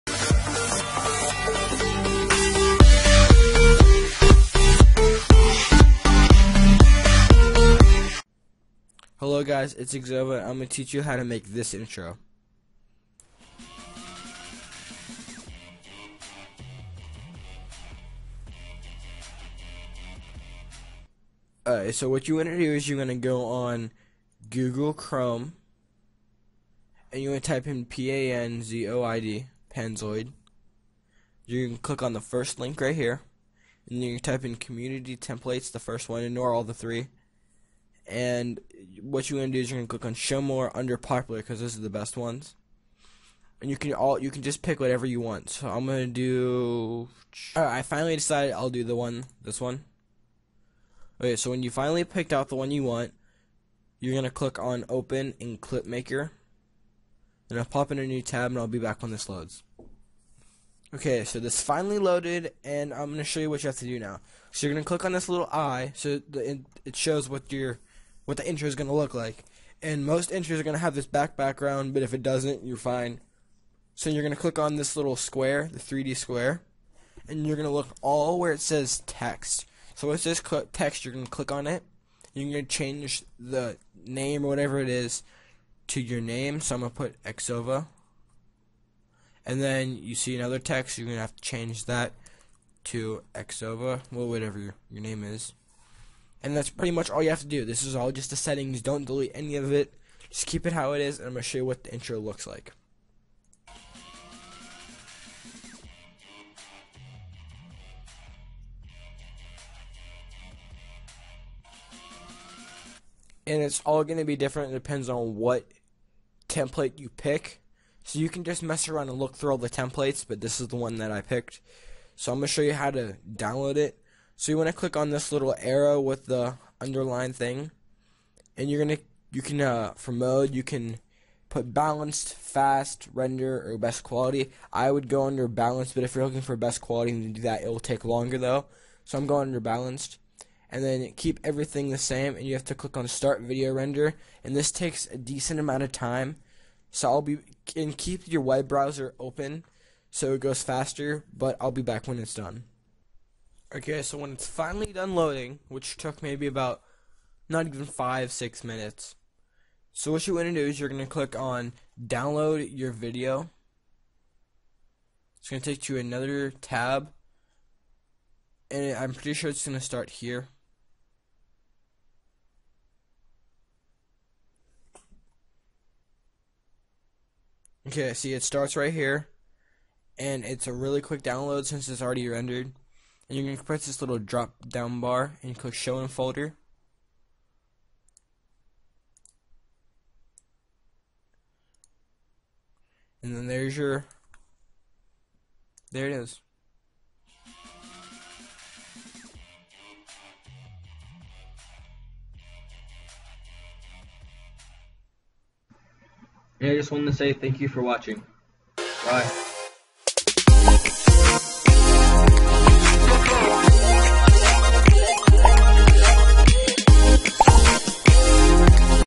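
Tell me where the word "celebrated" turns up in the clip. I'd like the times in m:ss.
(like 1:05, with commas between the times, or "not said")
not said.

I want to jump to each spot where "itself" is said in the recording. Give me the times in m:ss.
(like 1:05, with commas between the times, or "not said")
not said.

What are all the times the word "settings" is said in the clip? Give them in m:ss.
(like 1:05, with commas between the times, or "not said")
1:38.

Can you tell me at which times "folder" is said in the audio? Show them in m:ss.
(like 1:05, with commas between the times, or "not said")
3:06.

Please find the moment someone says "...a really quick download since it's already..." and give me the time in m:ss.
3:00.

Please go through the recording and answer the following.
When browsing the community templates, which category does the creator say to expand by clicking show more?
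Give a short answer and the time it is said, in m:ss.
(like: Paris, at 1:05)
Popular, at 0:40.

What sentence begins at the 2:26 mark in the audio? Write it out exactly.
So I'll be and keep your web browser open so it goes faster.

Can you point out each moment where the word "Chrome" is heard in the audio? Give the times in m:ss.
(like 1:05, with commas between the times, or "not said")
0:24.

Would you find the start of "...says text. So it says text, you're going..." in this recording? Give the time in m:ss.
1:18.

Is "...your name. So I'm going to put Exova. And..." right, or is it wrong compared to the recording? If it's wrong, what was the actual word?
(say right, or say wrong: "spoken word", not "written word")
right.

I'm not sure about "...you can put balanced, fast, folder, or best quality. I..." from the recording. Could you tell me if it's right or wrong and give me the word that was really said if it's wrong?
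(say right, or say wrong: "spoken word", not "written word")
wrong: "render", not "folder".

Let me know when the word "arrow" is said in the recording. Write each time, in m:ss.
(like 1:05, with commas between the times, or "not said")
2:05.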